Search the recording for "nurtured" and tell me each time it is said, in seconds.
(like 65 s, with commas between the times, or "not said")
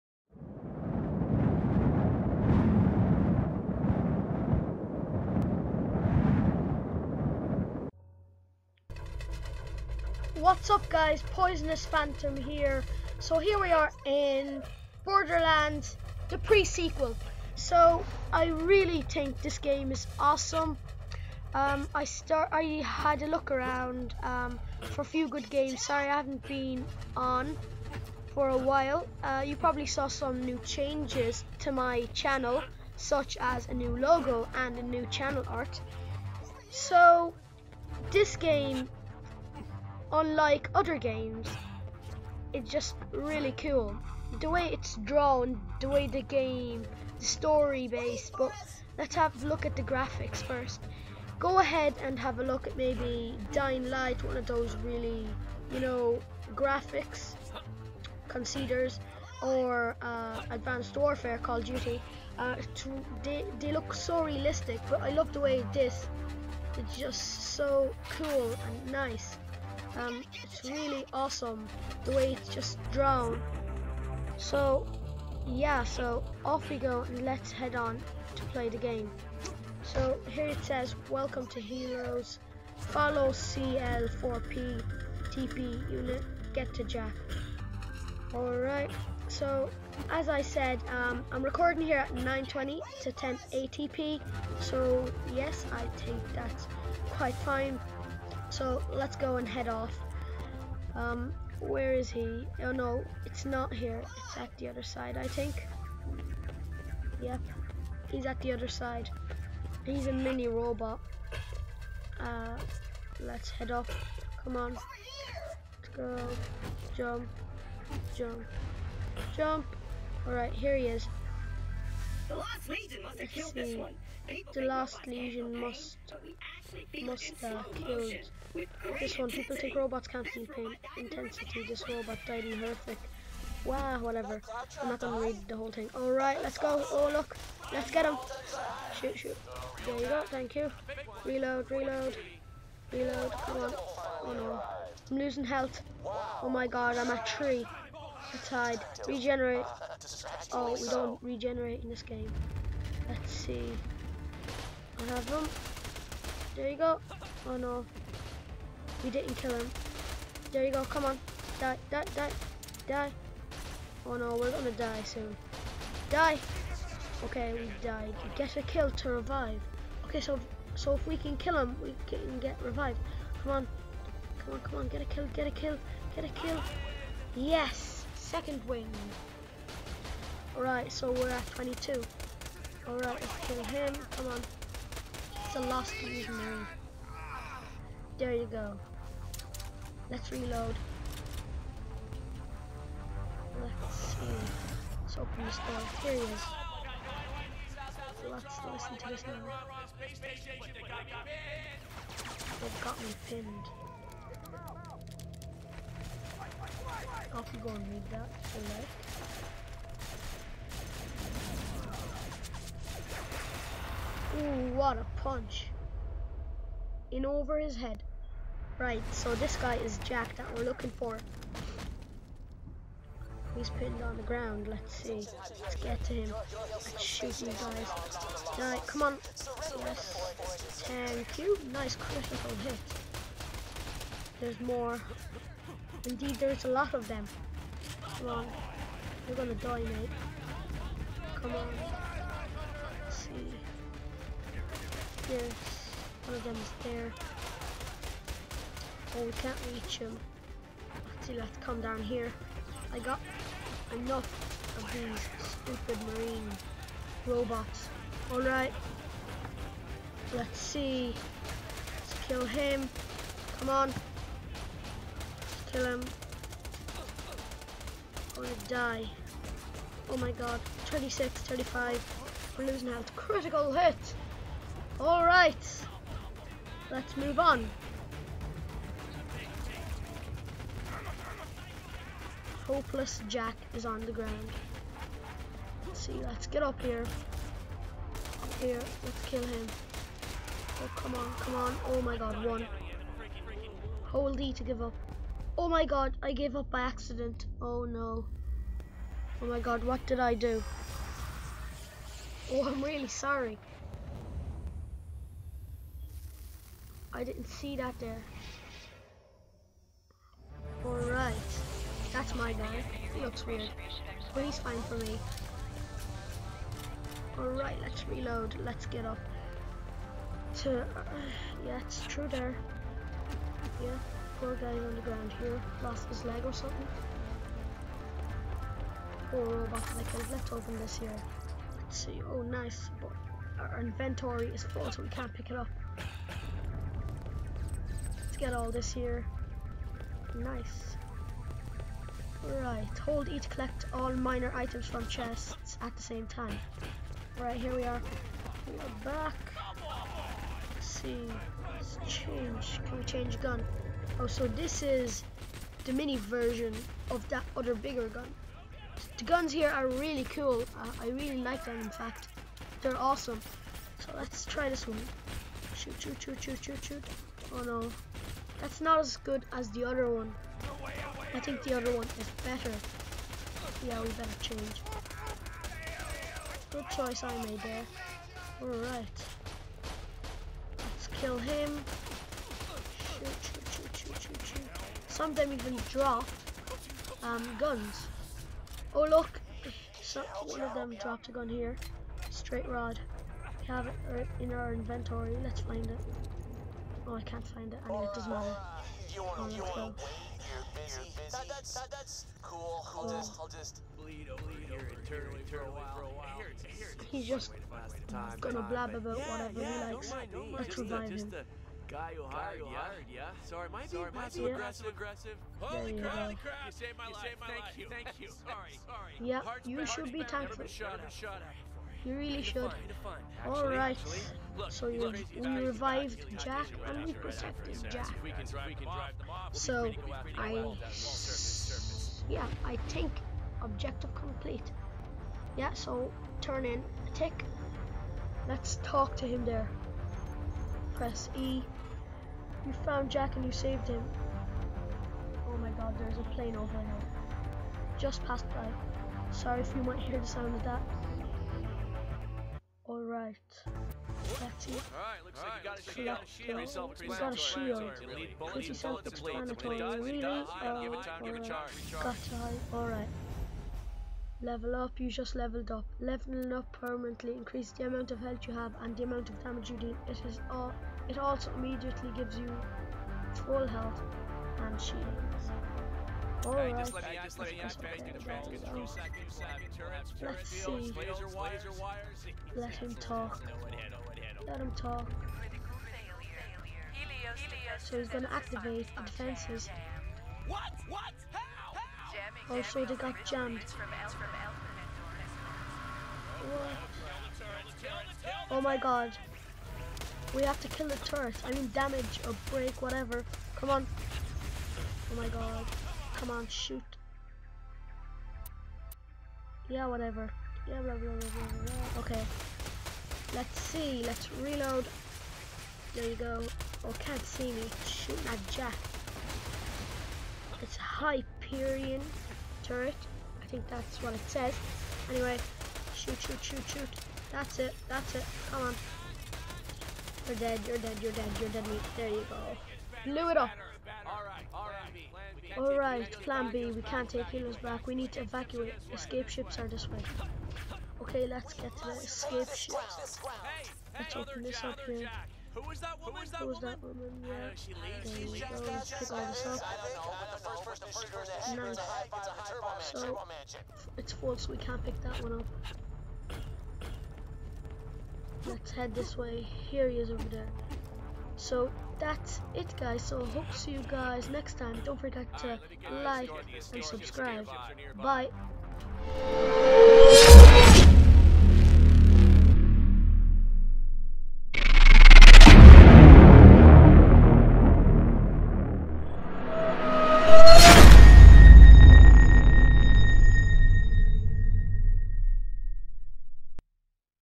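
not said.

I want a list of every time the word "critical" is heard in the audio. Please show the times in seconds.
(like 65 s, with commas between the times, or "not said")
231 s, 273 s.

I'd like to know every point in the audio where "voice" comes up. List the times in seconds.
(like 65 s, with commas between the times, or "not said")
not said.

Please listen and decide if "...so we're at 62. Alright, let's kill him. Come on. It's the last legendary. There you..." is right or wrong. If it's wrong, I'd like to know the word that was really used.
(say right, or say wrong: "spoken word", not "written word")
wrong: "22", not "62".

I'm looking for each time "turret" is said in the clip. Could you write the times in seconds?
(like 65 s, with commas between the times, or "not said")
500 s, 522 s.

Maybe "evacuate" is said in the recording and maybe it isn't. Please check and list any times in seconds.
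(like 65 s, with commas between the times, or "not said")
538 s.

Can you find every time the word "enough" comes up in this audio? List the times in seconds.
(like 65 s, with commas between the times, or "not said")
253 s.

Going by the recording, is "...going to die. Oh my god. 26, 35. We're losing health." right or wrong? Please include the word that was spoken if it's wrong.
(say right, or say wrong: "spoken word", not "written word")
right.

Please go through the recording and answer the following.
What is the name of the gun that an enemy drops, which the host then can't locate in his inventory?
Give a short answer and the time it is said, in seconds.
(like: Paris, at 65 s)
Straight rod, at 392 s.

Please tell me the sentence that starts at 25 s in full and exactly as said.
Sorry I haven't been on for a while.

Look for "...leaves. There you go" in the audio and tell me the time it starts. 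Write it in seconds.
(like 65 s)
548 s.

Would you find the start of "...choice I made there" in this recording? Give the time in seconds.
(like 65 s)
376 s.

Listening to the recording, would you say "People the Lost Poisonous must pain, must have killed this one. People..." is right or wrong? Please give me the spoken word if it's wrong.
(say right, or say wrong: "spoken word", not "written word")
wrong: "Legion", not "Poisonous".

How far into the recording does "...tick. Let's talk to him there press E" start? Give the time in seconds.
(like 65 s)
437 s.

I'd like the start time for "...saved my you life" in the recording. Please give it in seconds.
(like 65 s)
416 s.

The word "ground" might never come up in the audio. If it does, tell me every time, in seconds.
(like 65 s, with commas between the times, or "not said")
224 s, 284 s, 325 s.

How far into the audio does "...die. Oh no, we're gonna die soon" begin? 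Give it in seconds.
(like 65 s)
162 s.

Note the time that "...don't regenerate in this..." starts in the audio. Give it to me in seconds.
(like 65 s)
150 s.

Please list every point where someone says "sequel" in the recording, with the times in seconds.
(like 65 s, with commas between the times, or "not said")
16 s.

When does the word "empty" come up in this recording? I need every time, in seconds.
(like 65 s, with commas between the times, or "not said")
not said.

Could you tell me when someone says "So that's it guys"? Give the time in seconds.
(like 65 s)
561 s.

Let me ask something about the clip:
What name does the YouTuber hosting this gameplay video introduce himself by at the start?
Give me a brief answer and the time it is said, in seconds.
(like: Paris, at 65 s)
Poisonous Phantom, at 11 s.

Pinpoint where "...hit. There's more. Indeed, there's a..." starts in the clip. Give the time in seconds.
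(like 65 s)
232 s.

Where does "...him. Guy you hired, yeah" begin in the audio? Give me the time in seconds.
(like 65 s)
411 s.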